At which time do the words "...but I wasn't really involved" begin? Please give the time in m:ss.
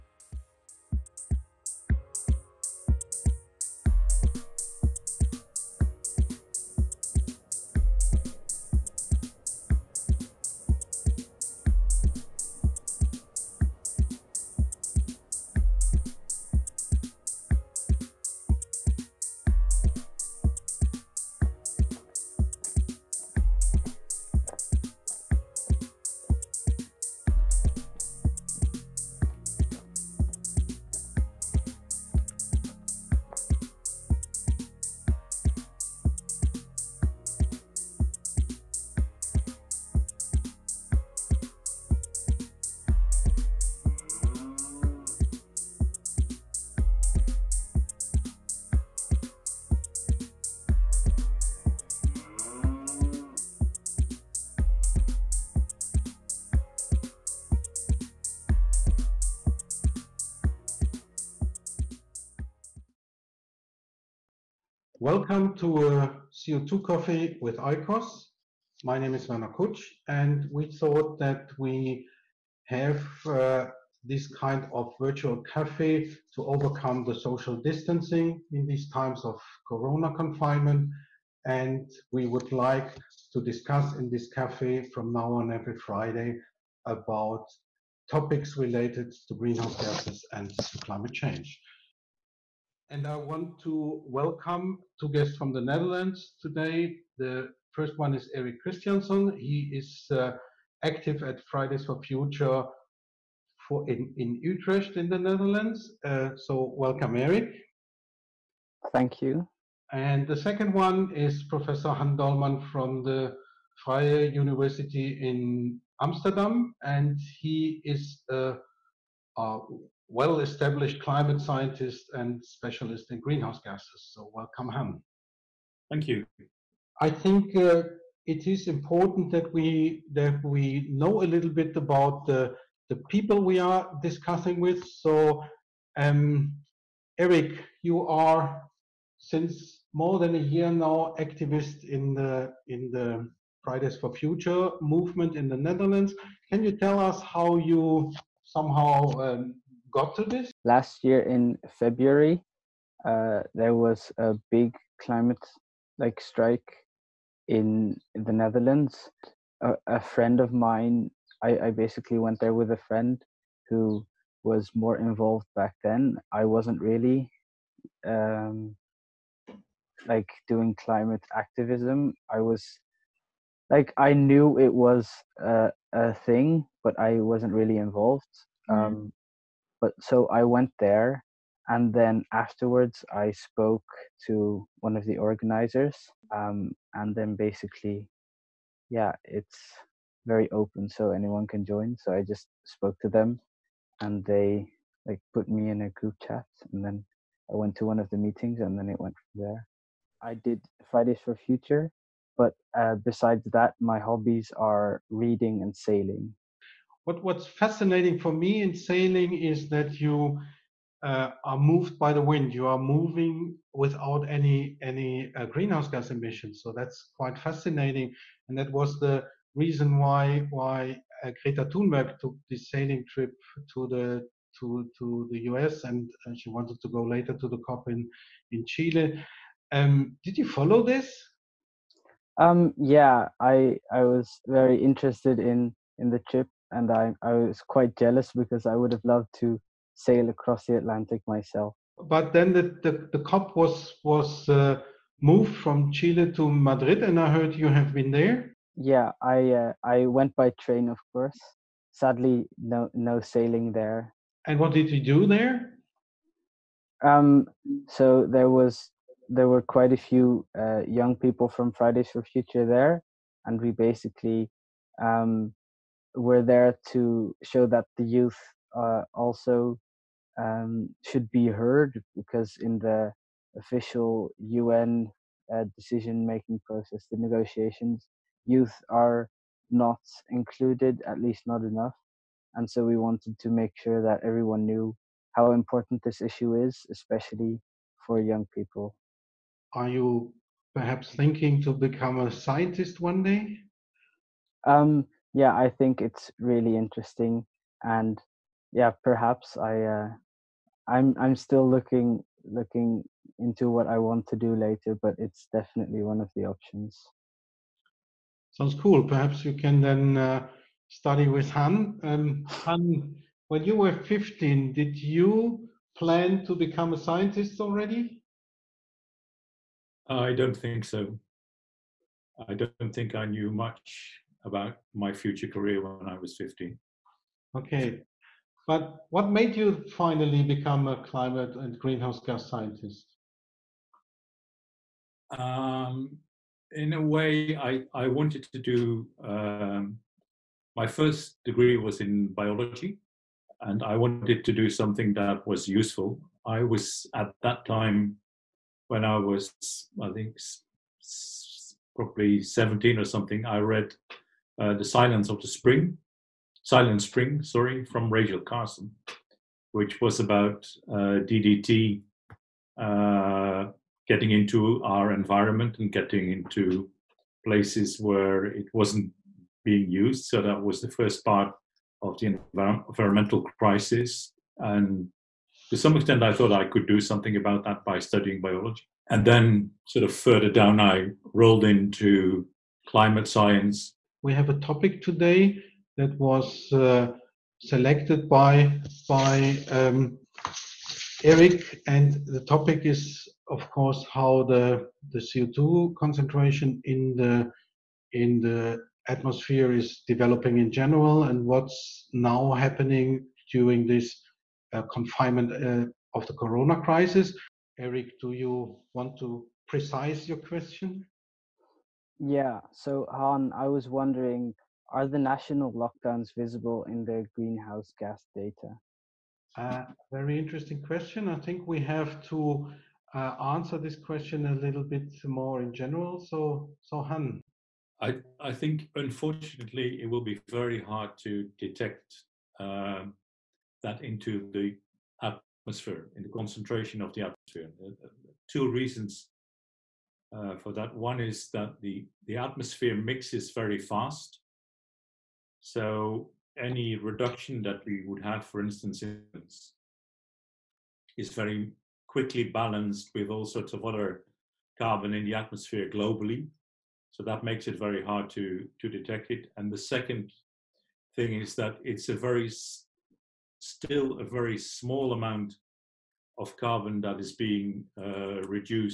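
2:56.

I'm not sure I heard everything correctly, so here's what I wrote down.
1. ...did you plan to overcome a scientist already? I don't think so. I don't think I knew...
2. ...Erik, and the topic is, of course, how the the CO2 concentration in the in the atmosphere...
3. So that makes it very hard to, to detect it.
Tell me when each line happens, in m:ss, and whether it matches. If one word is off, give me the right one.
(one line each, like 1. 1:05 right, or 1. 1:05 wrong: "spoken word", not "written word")
1. 5:14 wrong: "become", not "overcome"
2. 6:31 right
3. 7:37 right.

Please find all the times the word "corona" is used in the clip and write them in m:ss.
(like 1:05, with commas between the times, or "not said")
1:19, 6:46.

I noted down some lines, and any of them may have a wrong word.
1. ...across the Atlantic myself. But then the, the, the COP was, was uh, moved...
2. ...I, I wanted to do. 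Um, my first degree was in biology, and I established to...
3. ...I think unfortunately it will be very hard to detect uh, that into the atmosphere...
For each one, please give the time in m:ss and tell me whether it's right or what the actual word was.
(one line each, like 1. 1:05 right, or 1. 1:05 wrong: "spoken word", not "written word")
1. 4:00 right
2. 5:37 wrong: "wanted", not "established"
3. 7:08 right.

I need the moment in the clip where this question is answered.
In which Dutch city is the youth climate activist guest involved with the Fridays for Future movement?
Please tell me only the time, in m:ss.
1:44.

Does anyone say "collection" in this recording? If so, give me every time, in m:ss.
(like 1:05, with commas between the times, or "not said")
not said.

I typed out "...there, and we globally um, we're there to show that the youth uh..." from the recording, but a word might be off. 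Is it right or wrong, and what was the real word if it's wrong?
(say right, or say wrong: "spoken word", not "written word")
wrong: "basically", not "globally".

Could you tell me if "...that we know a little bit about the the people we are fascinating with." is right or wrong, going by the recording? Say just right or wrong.
wrong.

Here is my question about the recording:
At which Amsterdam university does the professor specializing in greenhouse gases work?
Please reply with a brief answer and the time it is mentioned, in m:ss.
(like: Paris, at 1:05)
Vrije University, at 1:53.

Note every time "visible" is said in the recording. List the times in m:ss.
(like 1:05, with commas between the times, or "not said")
6:56.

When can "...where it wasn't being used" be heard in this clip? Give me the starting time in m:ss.
6:07.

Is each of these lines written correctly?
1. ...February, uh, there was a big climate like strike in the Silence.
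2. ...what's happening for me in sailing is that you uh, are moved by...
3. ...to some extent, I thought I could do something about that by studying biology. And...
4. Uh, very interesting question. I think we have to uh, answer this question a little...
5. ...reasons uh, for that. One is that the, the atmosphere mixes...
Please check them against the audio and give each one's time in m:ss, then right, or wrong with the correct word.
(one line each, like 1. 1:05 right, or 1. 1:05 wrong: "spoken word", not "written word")
1. 2:31 wrong: "Netherlands", not "Silence"
2. 3:27 wrong: "fascinating", not "happening"
3. 6:15 right
4. 6:59 right
5. 7:18 right.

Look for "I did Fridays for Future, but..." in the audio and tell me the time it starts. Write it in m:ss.
3:20.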